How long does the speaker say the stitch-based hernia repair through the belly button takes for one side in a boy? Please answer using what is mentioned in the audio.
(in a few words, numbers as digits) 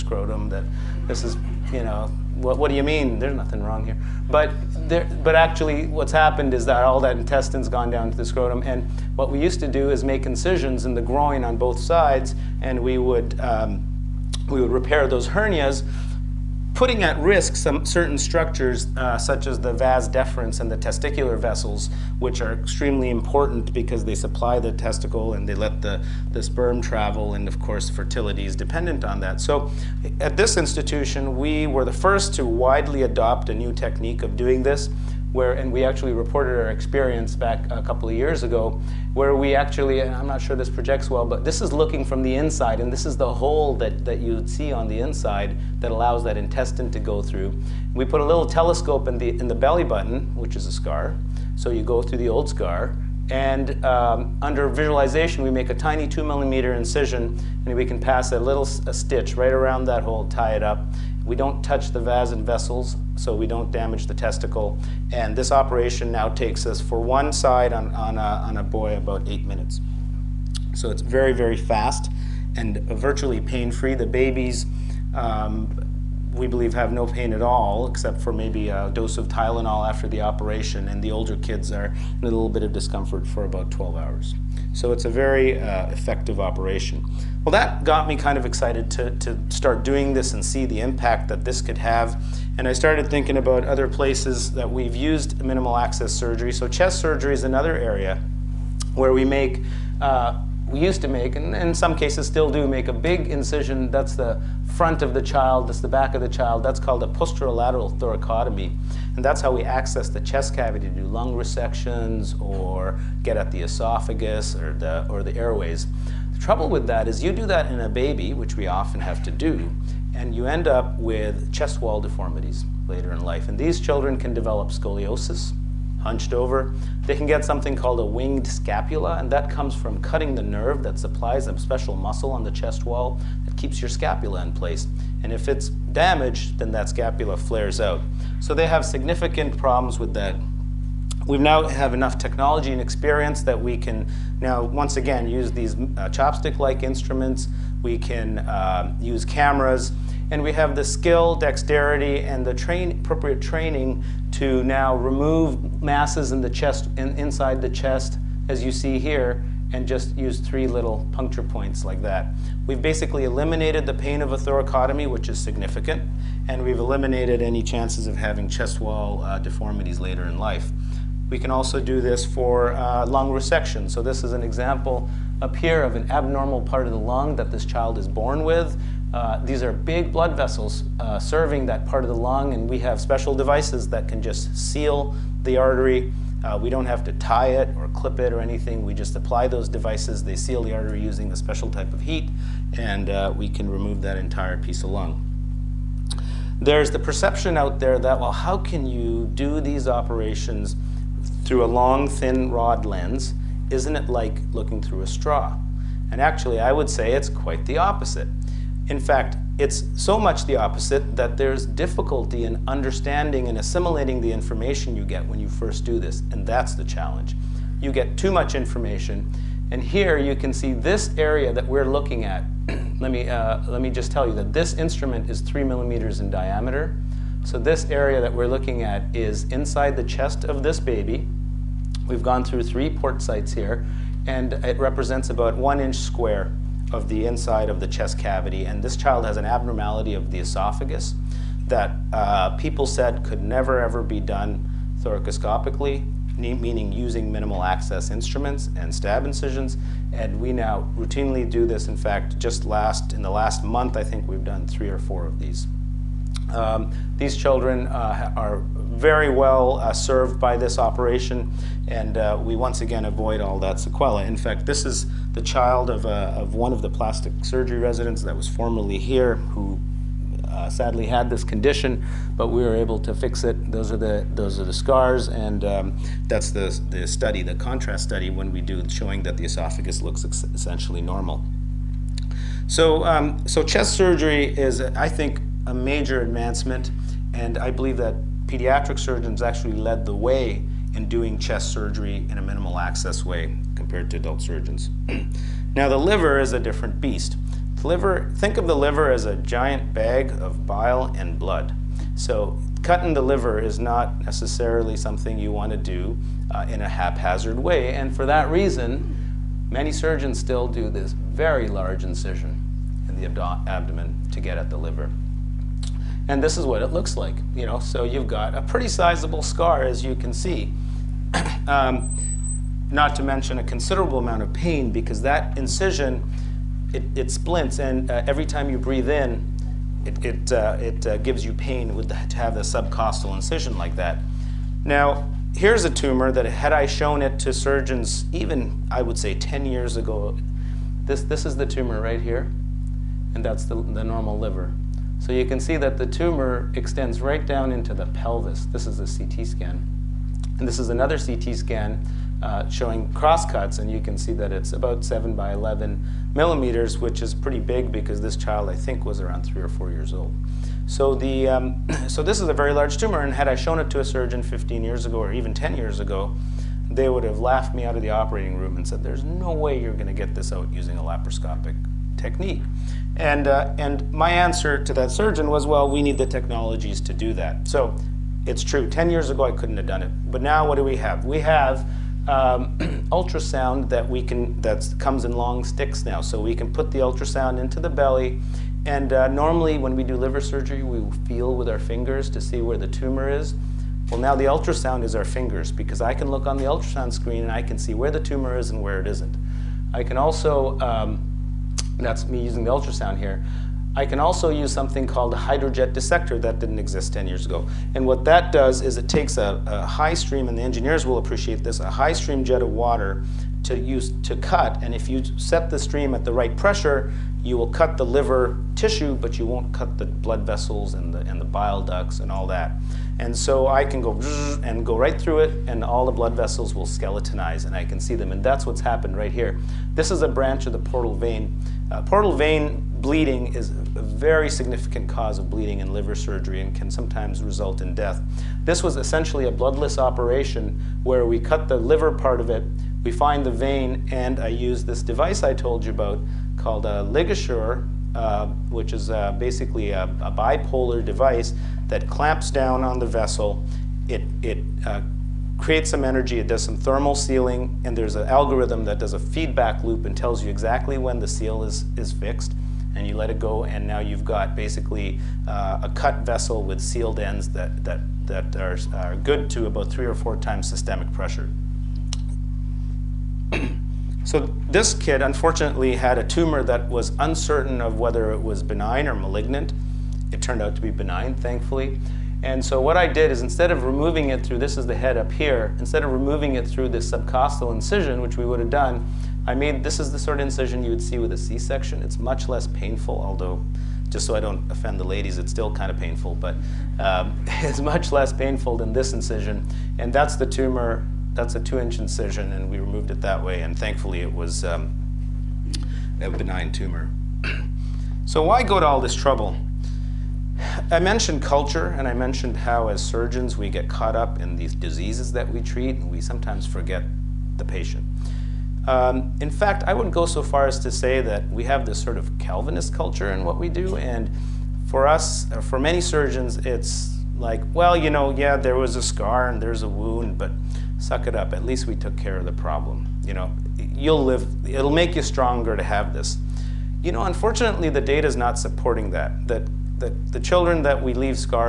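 8 minutes.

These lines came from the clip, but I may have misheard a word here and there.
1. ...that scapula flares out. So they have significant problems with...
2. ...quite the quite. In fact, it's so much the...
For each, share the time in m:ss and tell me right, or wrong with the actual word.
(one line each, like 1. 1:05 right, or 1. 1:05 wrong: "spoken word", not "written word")
1. 2:16 right
2. 3:27 wrong: "opposite", not "quite".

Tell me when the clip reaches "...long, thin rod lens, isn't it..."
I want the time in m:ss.
3:21.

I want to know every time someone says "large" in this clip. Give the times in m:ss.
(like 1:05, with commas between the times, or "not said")
5:11, 6:02.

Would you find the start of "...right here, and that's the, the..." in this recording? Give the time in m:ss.
5:42.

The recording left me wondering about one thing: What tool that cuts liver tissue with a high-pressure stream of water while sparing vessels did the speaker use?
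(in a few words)
Hydrojet dissector.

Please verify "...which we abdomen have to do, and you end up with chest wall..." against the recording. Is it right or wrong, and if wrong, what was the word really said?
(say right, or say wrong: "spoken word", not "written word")
wrong: "often", not "abdomen".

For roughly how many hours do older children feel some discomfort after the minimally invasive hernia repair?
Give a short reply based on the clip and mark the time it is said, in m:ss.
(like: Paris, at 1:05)
12, at 1:23.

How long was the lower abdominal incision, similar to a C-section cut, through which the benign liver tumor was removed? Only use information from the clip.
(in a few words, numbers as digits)
2 inches.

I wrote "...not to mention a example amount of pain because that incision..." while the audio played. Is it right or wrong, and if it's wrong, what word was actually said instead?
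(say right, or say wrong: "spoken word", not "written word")
wrong: "considerable", not "example".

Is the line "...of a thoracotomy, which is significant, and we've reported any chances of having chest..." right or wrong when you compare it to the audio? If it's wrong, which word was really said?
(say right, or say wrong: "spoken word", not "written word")
wrong: "eliminated", not "reported".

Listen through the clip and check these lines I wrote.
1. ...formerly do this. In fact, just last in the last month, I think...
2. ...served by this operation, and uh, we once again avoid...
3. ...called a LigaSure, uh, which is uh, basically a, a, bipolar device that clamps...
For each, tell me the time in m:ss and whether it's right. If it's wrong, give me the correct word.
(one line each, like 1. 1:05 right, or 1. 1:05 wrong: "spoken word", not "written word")
1. 4:10 wrong: "routinely", not "formerly"
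2. 4:19 right
3. 7:26 right.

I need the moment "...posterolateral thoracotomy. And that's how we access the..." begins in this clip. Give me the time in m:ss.
1:47.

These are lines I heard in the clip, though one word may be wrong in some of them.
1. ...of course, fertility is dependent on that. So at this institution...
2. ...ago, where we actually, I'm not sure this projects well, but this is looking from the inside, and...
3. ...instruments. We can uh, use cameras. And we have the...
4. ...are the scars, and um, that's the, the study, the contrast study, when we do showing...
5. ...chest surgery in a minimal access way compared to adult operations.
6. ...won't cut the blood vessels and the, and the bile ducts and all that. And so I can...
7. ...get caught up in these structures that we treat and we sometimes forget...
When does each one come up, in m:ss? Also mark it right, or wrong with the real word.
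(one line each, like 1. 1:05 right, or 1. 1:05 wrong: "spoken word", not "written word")
1. 0:27 right
2. 0:38 right
3. 2:26 right
4. 4:34 right
5. 4:51 wrong: "surgeons", not "operations"
6. 6:59 right
7. 8:33 wrong: "diseases", not "structures".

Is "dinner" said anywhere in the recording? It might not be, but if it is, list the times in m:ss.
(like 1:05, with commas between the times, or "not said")
not said.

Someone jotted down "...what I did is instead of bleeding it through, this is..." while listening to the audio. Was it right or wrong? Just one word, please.
wrong.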